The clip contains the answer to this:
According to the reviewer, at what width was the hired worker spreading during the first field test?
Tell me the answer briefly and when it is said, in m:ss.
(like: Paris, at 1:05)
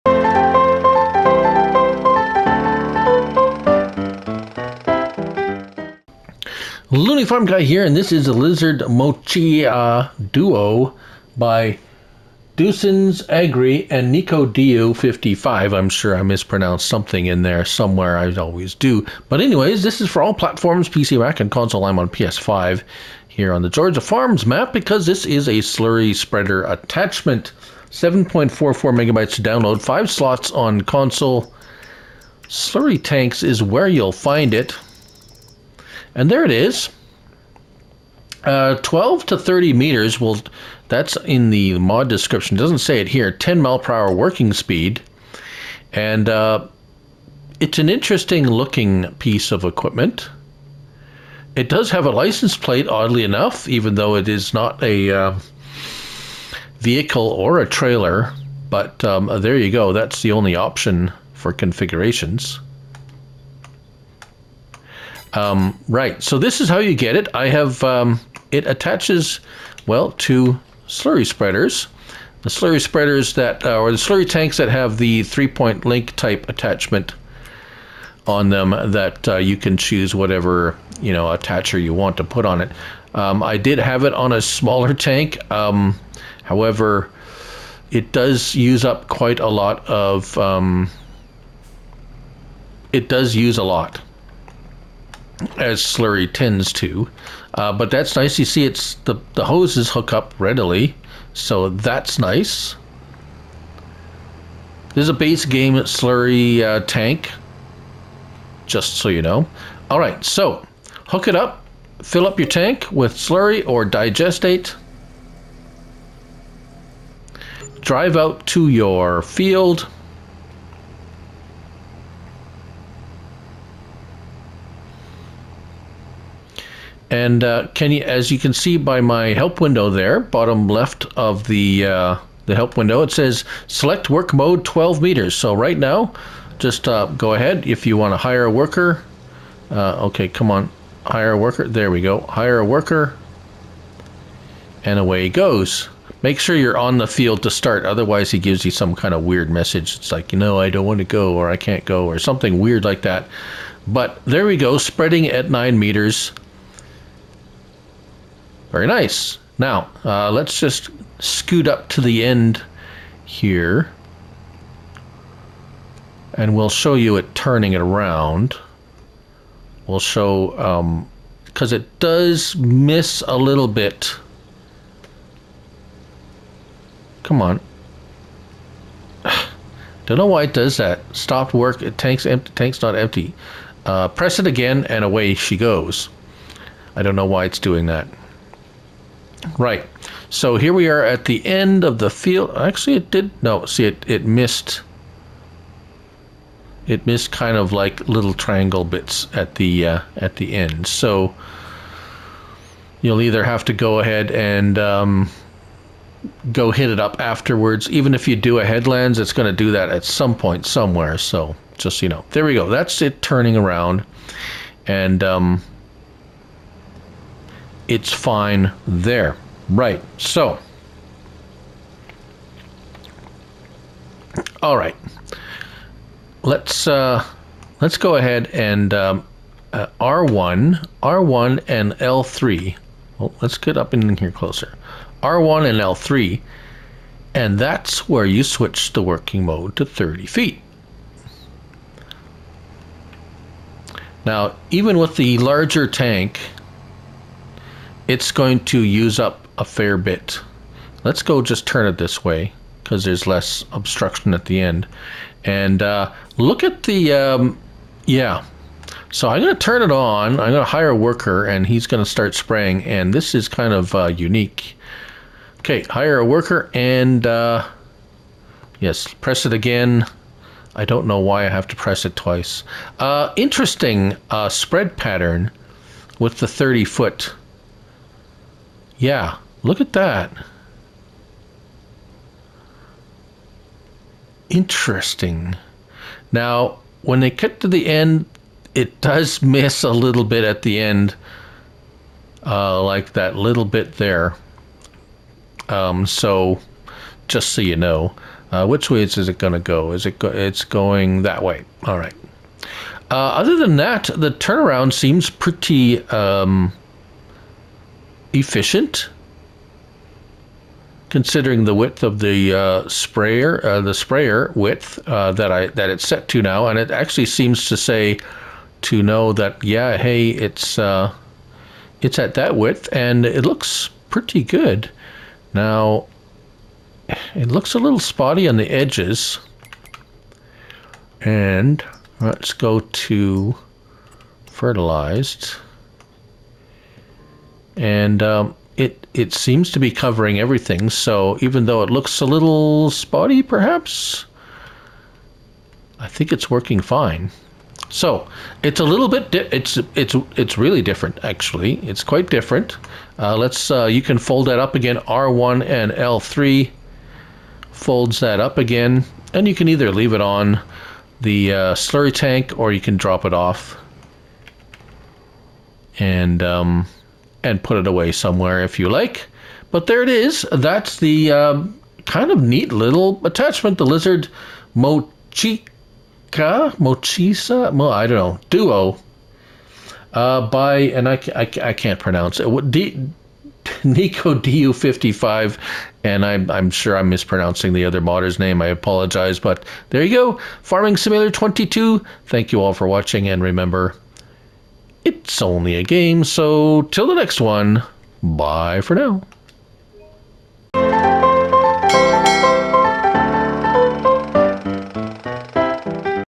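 9 meters, at 2:35.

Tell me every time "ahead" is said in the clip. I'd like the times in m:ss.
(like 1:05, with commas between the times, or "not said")
2:17, 3:23, 3:48.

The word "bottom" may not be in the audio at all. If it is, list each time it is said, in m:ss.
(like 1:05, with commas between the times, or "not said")
2:10.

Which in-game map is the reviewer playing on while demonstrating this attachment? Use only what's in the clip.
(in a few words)
Georgia Farms.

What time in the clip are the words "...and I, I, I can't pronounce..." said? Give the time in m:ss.
6:20.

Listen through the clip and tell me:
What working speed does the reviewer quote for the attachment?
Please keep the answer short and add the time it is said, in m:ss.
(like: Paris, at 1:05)
10 mph, at 0:43.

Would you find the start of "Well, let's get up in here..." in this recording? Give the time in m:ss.
3:53.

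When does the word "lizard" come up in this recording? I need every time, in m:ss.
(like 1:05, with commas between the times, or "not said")
0:08, 6:13.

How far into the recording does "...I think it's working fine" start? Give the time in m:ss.
5:45.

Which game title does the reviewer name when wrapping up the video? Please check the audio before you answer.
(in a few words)
Farming Simulator 22.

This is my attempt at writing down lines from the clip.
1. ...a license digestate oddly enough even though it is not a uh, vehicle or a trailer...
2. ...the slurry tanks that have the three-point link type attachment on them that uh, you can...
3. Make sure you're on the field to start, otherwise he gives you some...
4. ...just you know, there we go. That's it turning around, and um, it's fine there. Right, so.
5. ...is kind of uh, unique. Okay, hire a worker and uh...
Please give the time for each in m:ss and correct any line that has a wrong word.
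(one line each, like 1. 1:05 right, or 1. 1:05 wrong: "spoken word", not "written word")
1. 0:52 wrong: "plate", not "digestate"
2. 1:13 right
3. 2:26 right
4. 3:31 right
5. 4:23 right.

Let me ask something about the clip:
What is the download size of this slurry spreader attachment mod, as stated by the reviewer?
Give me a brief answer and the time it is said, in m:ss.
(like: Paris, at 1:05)
7.44 megabytes, at 0:27.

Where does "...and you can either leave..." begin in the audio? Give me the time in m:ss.
5:59.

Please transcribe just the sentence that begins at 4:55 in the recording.
Um, so, just so you know, uh, which way is it going to go?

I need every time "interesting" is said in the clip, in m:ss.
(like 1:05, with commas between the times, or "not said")
0:47, 4:33, 4:44.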